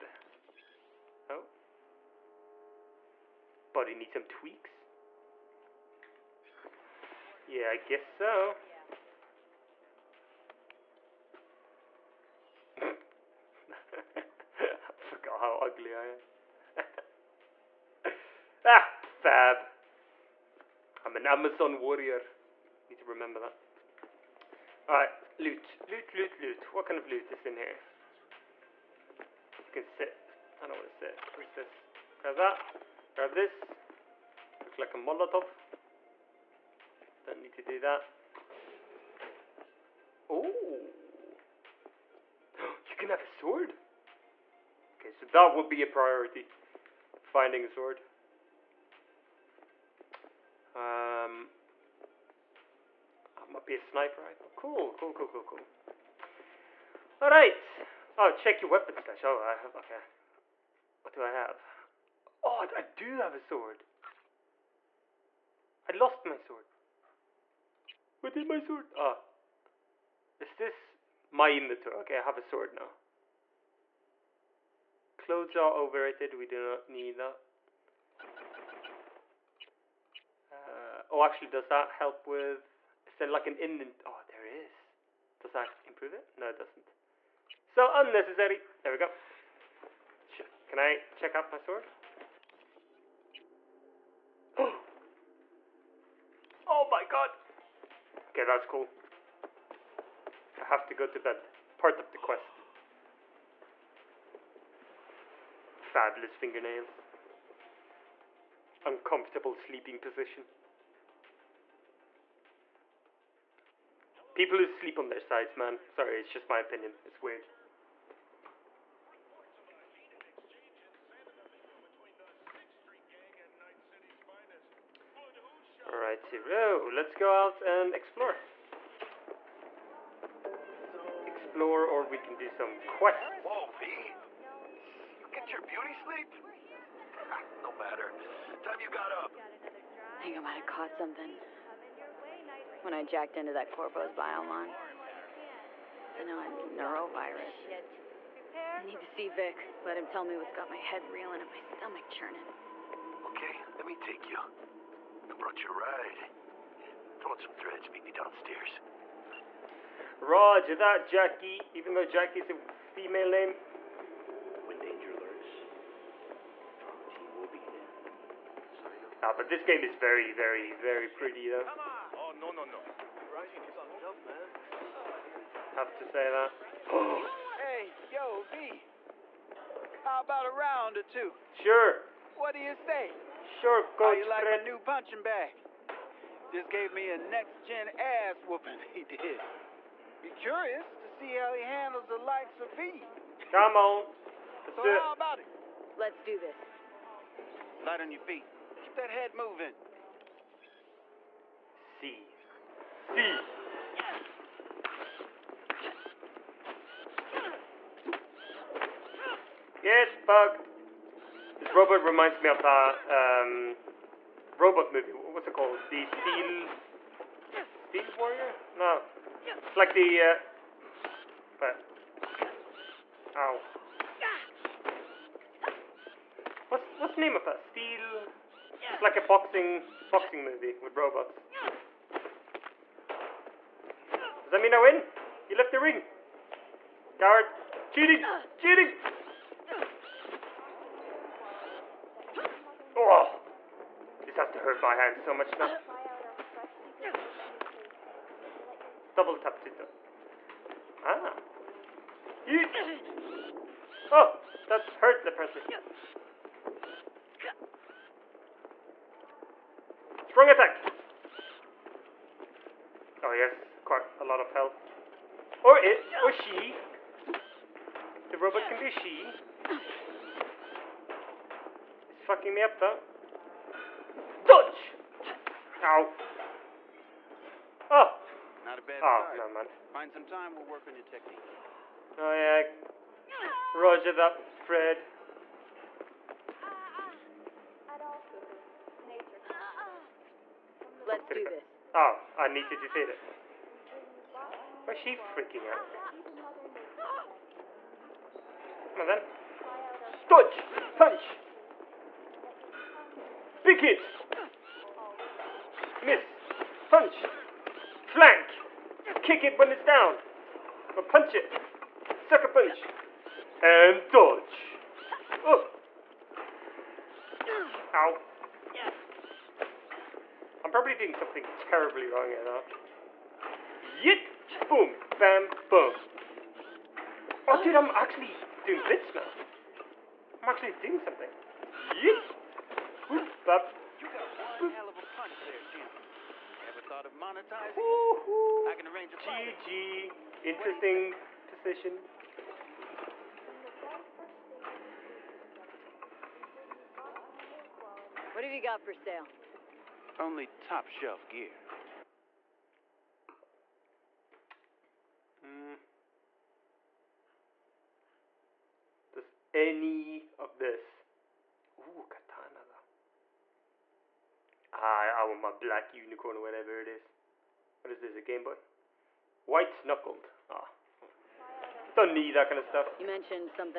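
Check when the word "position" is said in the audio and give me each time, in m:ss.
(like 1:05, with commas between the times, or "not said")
1:49, 5:41.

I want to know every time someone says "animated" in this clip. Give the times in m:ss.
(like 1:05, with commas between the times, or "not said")
not said.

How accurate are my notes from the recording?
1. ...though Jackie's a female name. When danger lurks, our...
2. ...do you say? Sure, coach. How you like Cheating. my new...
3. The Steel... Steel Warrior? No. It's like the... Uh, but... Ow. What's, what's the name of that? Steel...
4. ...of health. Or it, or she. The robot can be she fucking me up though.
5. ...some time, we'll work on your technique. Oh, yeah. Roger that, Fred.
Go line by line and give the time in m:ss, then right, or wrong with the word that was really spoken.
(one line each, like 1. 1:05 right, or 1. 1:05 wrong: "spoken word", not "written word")
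1. 2:41 right
2. 3:02 wrong: "Fred", not "Cheating"
3. 3:35 right
4. 4:24 right
5. 4:40 right.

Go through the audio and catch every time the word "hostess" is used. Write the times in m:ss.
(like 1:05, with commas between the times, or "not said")
not said.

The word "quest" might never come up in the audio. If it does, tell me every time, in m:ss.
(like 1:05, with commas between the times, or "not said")
1:42, 2:12.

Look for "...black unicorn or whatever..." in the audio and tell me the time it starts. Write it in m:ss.
6:05.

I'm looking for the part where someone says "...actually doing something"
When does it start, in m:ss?
5:30.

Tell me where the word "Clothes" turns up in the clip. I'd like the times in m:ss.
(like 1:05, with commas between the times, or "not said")
1:15.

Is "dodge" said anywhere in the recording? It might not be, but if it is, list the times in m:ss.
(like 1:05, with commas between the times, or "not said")
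4:34, 5:00, 5:14.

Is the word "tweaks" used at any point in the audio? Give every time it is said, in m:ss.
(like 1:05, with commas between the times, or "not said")
0:04.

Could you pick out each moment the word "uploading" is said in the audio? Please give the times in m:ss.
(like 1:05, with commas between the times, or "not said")
not said.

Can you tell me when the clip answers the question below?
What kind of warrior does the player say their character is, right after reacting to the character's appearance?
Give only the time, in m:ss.
0:21.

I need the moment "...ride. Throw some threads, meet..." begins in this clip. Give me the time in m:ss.
2:35.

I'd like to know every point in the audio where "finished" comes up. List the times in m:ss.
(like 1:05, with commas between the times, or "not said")
not said.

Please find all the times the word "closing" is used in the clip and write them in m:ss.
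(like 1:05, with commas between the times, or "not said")
not said.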